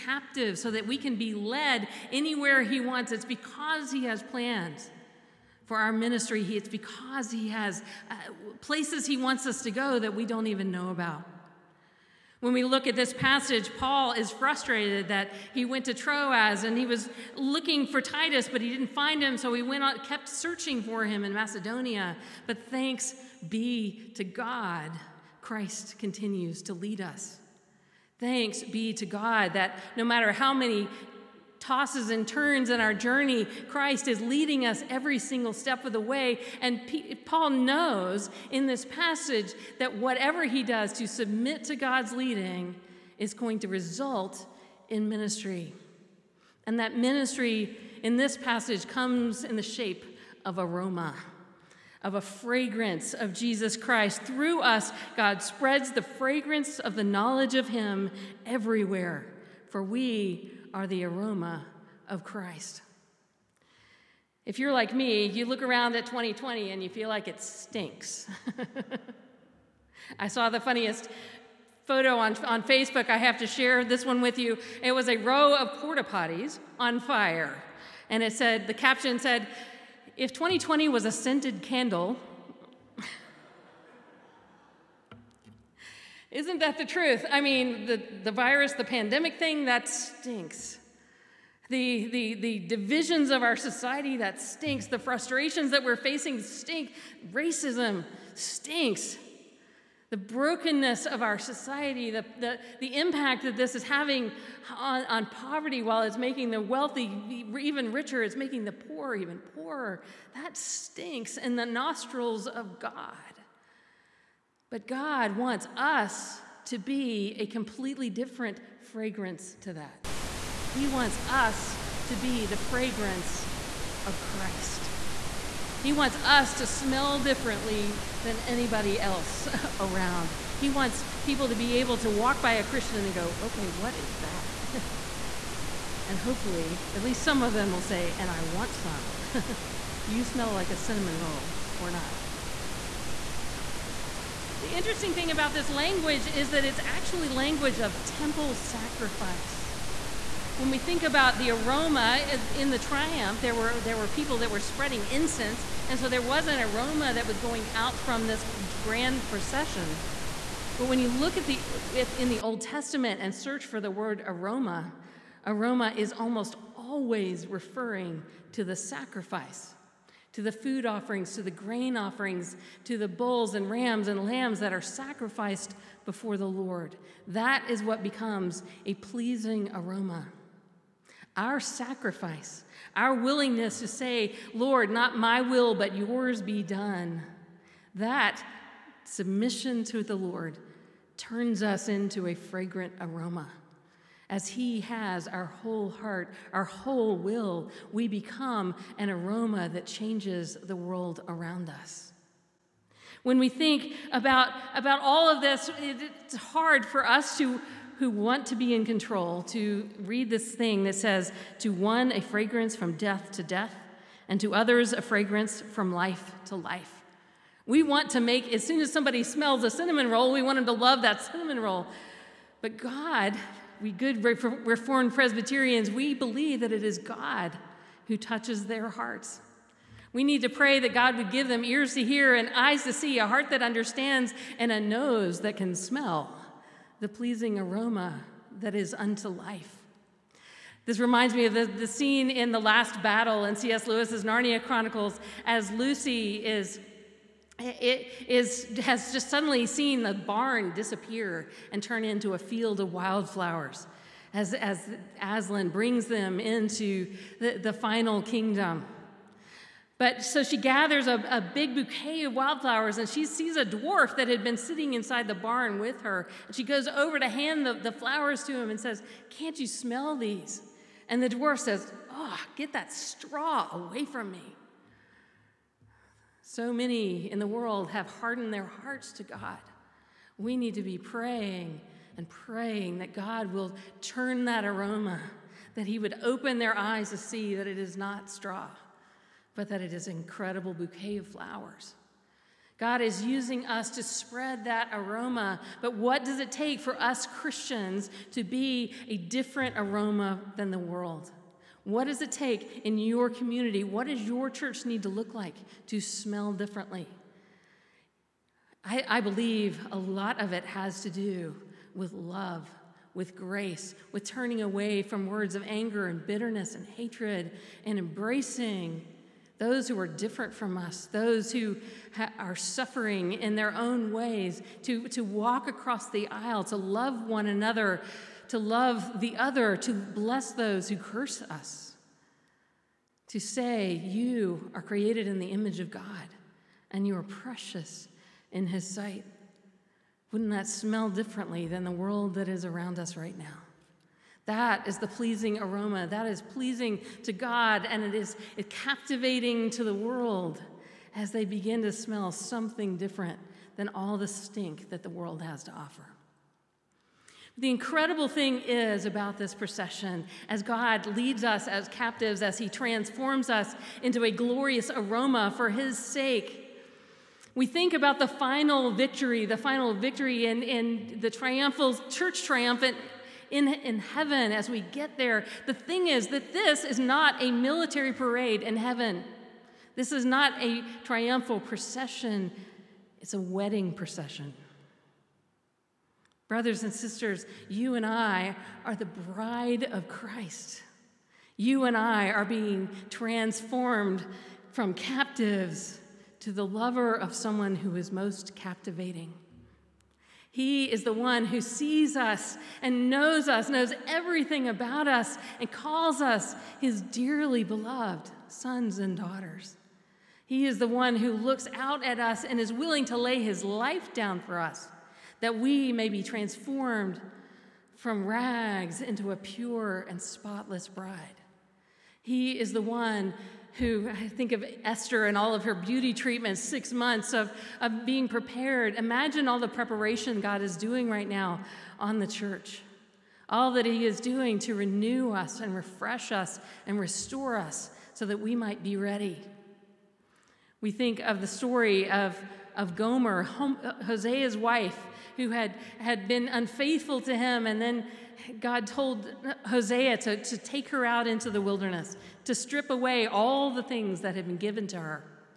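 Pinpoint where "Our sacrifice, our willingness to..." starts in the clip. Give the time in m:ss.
3:01.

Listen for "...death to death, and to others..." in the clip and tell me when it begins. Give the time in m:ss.
3:32.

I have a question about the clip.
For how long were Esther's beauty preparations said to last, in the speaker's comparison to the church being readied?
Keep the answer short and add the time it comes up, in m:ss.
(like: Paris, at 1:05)
6 months, at 7:06.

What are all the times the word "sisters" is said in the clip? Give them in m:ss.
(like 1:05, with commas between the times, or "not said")
6:26.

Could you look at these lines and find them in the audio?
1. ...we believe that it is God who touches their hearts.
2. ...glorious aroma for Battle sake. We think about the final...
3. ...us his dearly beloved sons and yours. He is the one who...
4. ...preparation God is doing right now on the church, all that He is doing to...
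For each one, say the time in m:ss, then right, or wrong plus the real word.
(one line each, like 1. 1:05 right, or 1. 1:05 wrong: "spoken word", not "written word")
1. 3:45 right
2. 6:04 wrong: "His", not "Battle"
3. 6:46 wrong: "daughters", not "yours"
4. 7:09 right.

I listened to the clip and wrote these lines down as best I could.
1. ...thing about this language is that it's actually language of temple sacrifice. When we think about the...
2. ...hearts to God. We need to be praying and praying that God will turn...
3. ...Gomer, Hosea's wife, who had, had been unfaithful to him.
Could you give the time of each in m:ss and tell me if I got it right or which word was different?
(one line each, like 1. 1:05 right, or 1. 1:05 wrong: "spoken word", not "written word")
1. 2:25 right
2. 4:38 right
3. 7:22 right.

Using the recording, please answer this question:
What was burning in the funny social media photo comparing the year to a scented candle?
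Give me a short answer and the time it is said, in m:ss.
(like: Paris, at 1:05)
porta potties, at 1:15.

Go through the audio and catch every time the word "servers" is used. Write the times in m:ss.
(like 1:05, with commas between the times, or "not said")
not said.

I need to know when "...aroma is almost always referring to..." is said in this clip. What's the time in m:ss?
2:45.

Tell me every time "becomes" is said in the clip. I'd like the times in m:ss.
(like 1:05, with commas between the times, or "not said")
2:58, 3:18.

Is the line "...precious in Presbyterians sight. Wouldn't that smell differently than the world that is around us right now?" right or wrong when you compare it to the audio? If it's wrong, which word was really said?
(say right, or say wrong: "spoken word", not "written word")
wrong: "His", not "Presbyterians".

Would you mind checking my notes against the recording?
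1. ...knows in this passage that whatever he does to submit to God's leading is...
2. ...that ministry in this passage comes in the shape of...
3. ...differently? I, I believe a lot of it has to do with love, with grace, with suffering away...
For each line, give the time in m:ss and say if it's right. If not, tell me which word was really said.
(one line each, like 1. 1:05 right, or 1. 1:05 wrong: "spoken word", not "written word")
1. 0:37 right
2. 0:46 right
3. 5:06 wrong: "turning", not "suffering".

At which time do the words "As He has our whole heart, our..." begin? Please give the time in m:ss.
3:14.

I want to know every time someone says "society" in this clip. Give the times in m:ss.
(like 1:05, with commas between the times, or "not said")
1:33, 1:41.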